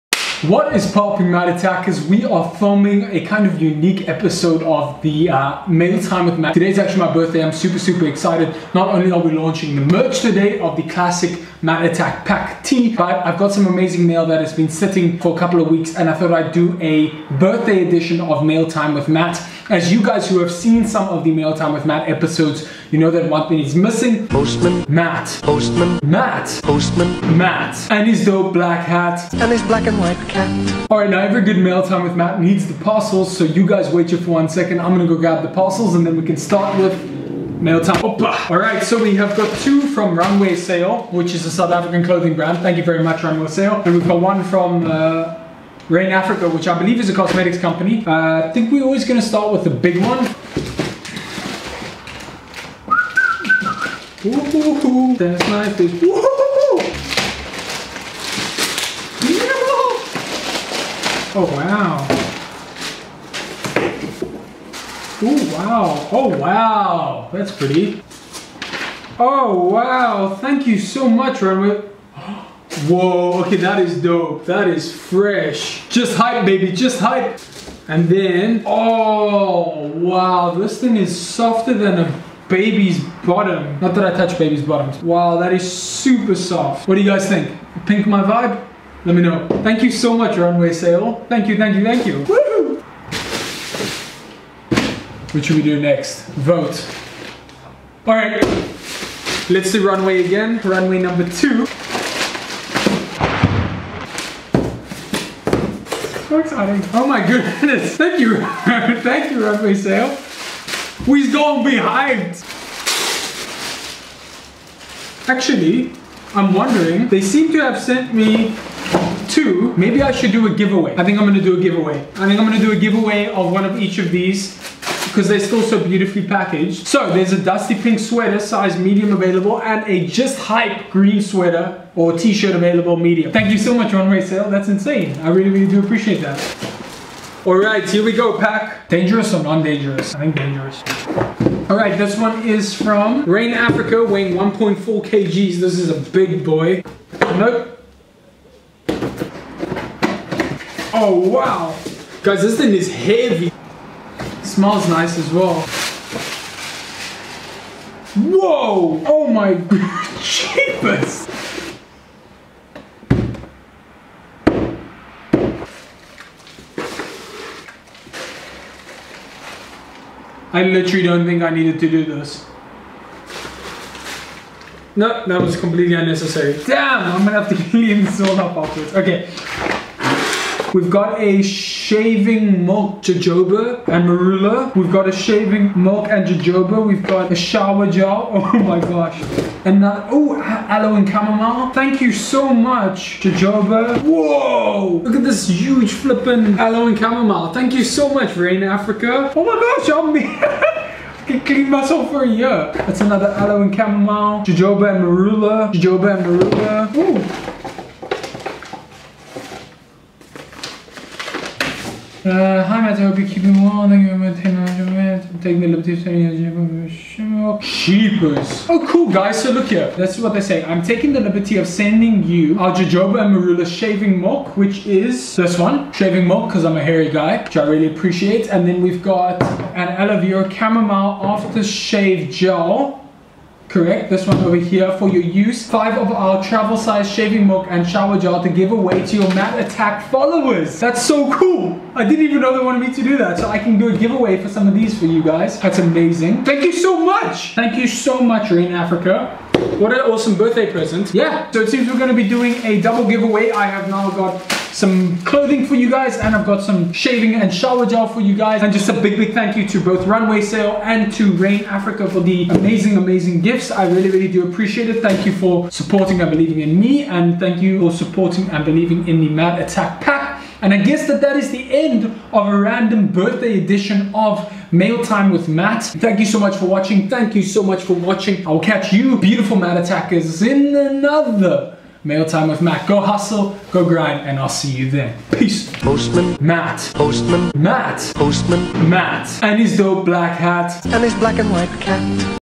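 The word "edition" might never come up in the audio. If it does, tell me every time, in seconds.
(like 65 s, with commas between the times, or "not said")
17 s, 273 s.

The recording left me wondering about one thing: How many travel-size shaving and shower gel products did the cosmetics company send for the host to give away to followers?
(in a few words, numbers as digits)
5.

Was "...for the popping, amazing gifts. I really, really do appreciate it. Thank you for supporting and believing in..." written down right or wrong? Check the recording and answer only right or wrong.
wrong.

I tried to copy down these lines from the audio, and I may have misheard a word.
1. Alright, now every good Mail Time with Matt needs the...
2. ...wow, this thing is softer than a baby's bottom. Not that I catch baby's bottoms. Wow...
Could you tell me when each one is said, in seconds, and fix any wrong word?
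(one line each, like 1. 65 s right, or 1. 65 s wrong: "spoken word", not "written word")
1. 30 s right
2. 79 s wrong: "touch", not "catch".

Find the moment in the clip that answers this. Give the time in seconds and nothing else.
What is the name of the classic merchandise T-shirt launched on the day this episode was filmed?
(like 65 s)
11 s.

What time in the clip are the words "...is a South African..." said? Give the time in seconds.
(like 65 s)
41 s.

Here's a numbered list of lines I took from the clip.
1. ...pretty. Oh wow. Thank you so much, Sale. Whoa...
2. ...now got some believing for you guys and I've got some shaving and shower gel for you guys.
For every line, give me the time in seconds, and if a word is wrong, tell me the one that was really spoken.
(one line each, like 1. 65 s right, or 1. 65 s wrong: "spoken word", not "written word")
1. 67 s wrong: "Runway", not "Sale"
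2. 253 s wrong: "clothing", not "believing".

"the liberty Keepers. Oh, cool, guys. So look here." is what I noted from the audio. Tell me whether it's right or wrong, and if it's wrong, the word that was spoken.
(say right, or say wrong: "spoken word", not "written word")
right.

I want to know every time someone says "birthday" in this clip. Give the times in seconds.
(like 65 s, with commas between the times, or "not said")
7 s, 17 s, 250 s, 273 s.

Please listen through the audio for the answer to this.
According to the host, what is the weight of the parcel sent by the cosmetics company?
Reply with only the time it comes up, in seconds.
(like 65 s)
144 s.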